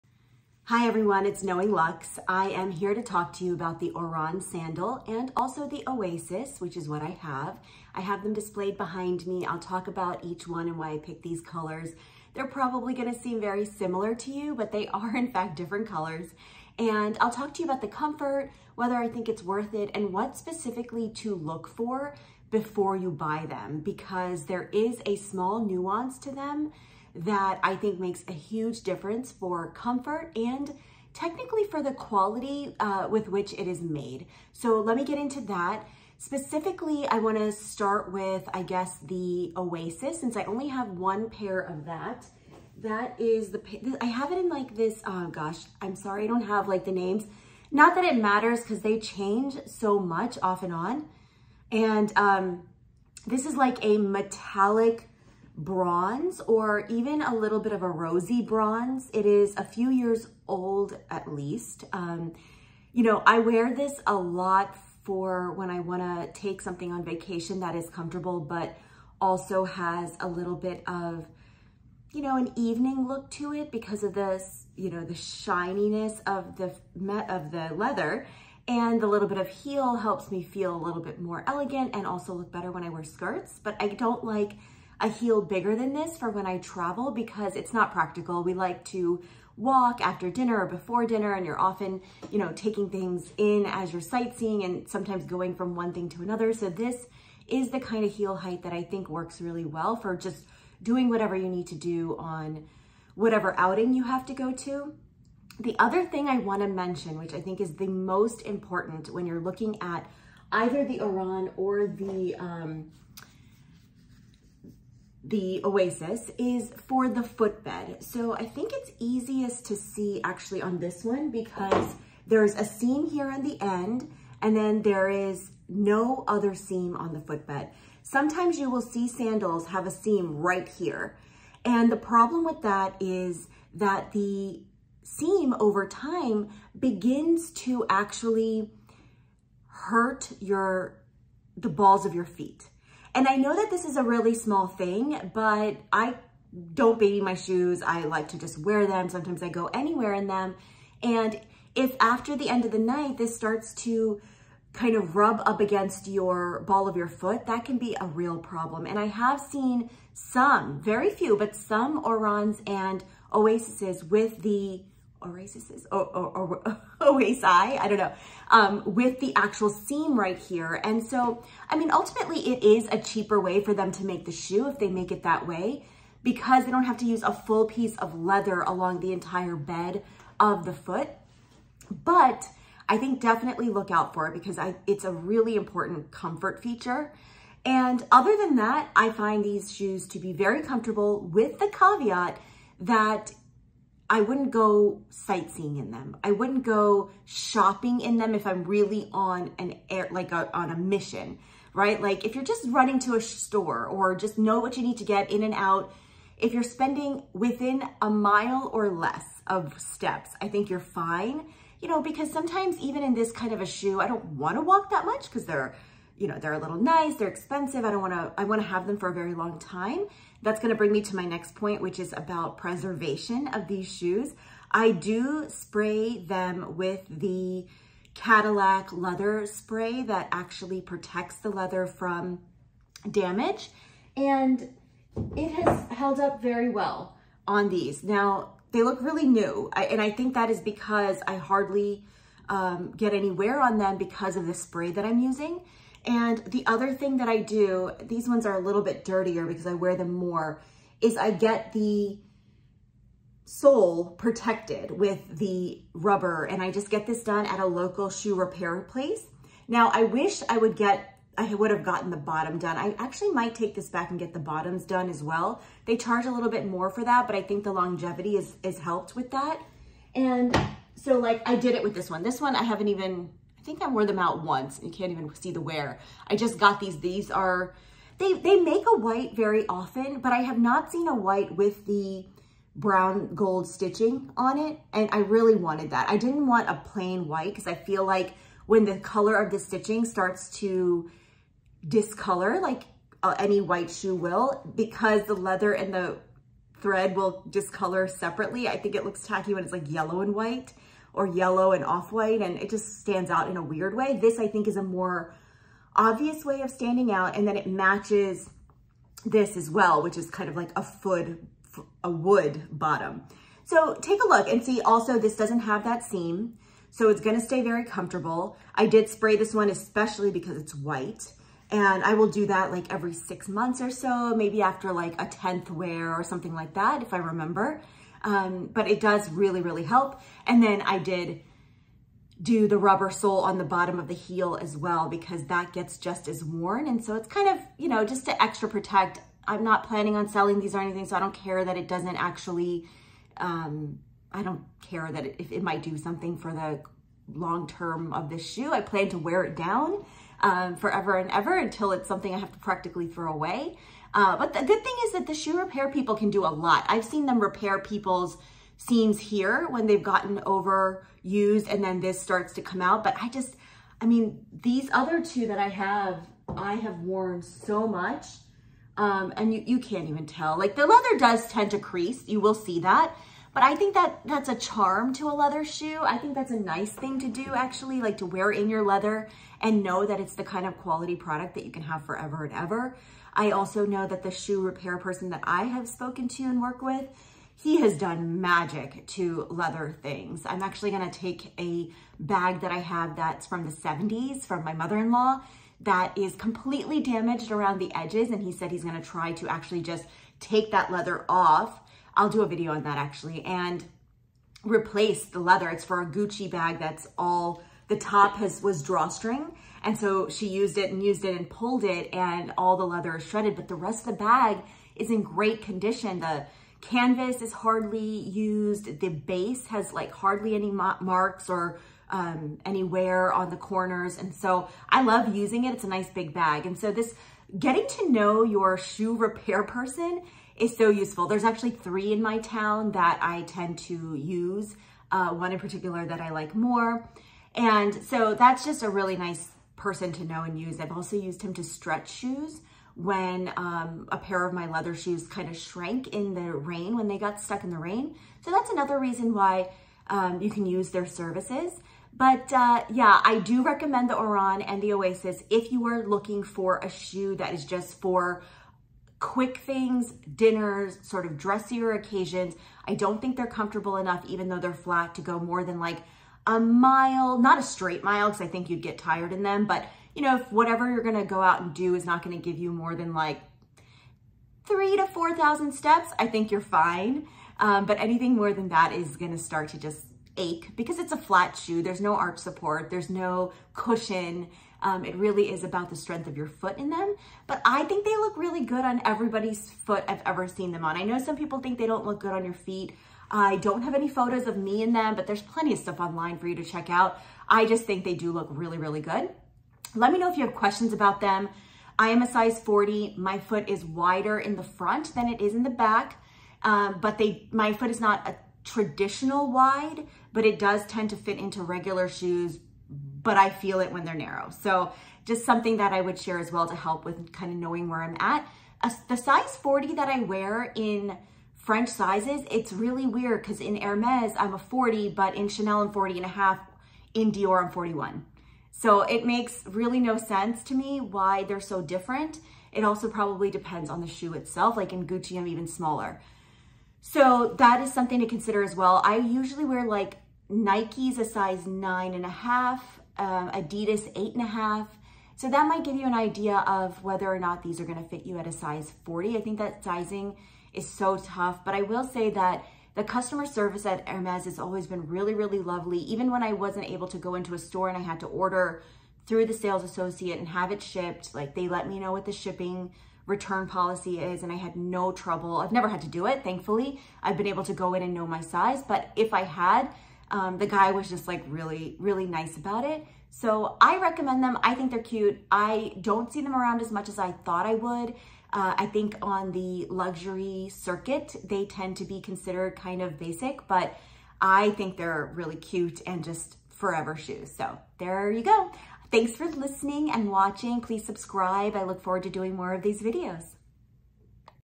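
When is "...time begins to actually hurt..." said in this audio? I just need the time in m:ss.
2:15.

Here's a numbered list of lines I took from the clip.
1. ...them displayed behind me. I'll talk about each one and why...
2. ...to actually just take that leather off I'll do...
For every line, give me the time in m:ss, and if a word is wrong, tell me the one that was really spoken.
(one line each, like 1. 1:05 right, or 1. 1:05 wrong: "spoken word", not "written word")
1. 0:08 right
2. 6:39 right.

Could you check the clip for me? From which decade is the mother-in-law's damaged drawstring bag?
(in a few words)
the 70s.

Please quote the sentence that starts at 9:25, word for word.
I've never had to do it, thankfully.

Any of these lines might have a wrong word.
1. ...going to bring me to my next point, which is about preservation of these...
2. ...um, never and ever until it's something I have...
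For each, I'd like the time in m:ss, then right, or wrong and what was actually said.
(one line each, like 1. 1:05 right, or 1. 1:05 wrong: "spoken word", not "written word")
1. 3:40 right
2. 5:50 wrong: "forever", not "never".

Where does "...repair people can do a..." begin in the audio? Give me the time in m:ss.
5:55.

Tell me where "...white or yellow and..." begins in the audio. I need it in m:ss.
5:00.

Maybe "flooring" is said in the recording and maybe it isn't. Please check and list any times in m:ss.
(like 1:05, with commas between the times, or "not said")
not said.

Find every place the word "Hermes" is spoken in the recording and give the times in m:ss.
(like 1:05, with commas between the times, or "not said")
8:43, 9:14.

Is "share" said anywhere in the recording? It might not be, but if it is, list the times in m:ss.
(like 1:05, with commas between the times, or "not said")
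8:36.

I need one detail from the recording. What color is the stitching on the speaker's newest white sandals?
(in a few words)
brown gold.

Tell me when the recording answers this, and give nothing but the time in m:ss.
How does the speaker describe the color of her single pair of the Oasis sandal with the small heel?
0:53.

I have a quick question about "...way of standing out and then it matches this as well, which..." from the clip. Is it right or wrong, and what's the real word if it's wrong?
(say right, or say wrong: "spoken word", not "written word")
right.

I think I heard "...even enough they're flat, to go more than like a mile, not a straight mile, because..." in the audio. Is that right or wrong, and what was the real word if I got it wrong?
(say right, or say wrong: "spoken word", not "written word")
wrong: "though", not "enough".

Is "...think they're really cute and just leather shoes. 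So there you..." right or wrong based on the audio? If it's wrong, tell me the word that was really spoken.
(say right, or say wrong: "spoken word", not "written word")
wrong: "forever", not "leather".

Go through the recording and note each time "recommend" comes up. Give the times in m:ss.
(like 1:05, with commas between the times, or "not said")
7:33, 9:33.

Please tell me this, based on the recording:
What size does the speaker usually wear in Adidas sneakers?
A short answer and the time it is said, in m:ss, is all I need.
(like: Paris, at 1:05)
8.5, at 9:04.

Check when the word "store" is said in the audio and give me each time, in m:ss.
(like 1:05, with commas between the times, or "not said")
3:23, 9:17.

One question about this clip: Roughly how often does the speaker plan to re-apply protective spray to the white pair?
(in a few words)
every six months.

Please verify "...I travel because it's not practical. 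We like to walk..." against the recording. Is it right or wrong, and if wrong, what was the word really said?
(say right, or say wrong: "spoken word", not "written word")
right.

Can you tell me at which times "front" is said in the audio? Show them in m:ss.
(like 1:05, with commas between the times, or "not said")
8:24.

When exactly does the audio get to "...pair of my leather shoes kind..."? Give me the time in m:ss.
7:24.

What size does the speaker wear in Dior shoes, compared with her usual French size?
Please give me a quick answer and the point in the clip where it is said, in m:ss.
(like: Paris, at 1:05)
41, at 8:47.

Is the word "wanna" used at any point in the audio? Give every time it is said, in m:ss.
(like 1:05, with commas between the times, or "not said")
0:37, 1:05, 1:46.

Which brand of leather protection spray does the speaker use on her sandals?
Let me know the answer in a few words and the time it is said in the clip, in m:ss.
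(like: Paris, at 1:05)
Cadillac, at 3:48.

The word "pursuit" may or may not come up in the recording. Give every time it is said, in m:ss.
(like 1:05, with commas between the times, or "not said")
not said.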